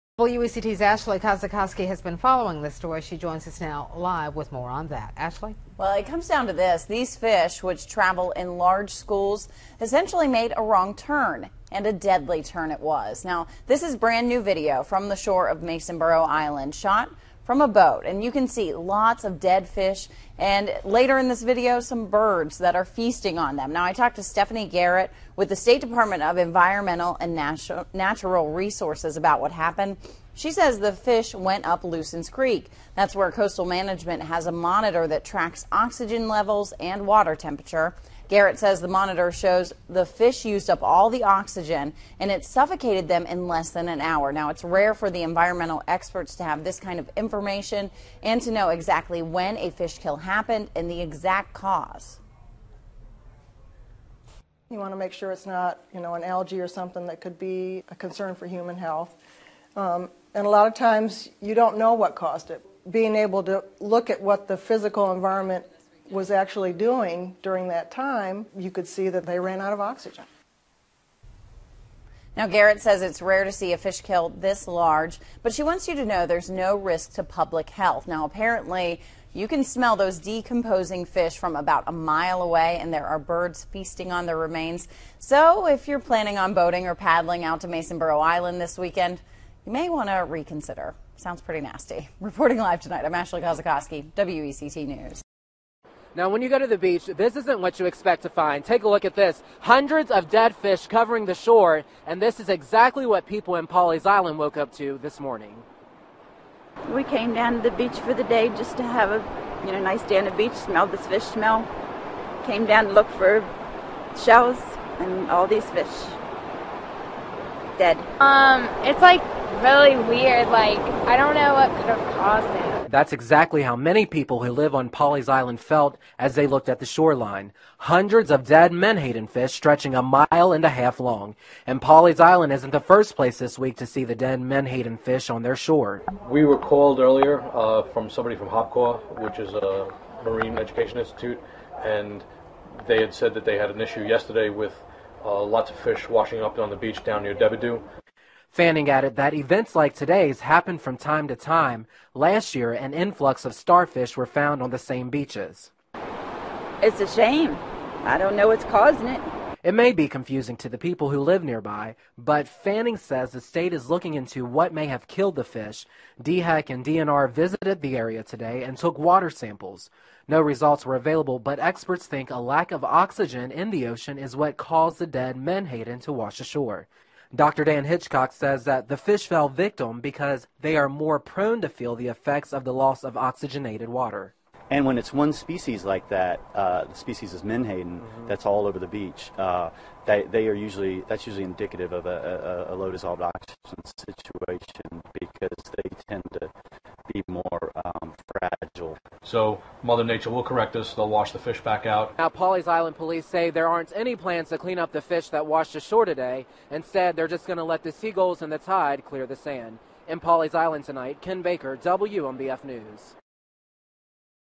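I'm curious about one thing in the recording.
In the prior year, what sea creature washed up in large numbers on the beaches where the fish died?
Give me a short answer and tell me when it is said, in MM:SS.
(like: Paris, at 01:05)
Starfish, at 02:33.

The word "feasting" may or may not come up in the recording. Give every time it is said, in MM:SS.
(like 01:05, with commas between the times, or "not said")
00:22, 01:23.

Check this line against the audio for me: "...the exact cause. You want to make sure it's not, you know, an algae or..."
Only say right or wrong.
right.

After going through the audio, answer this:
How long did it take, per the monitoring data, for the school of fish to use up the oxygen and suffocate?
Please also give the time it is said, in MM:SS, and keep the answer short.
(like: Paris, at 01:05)
Less than an hour, at 00:43.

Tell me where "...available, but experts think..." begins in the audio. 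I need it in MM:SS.
02:50.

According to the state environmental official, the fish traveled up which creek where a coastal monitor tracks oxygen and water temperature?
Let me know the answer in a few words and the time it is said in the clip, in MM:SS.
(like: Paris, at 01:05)
Lucens Creek, at 00:31.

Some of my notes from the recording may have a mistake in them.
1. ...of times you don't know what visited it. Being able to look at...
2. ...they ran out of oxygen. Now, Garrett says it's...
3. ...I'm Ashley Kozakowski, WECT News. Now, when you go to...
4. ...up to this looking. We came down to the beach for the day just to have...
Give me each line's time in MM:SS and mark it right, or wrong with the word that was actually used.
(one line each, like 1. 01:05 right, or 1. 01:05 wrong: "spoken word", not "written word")
1. 01:00 wrong: "caused", not "visited"
2. 01:09 right
3. 01:33 right
4. 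01:44 wrong: "morning", not "looking".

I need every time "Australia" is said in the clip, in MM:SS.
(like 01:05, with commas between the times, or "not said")
not said.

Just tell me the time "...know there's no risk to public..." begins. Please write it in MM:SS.
01:16.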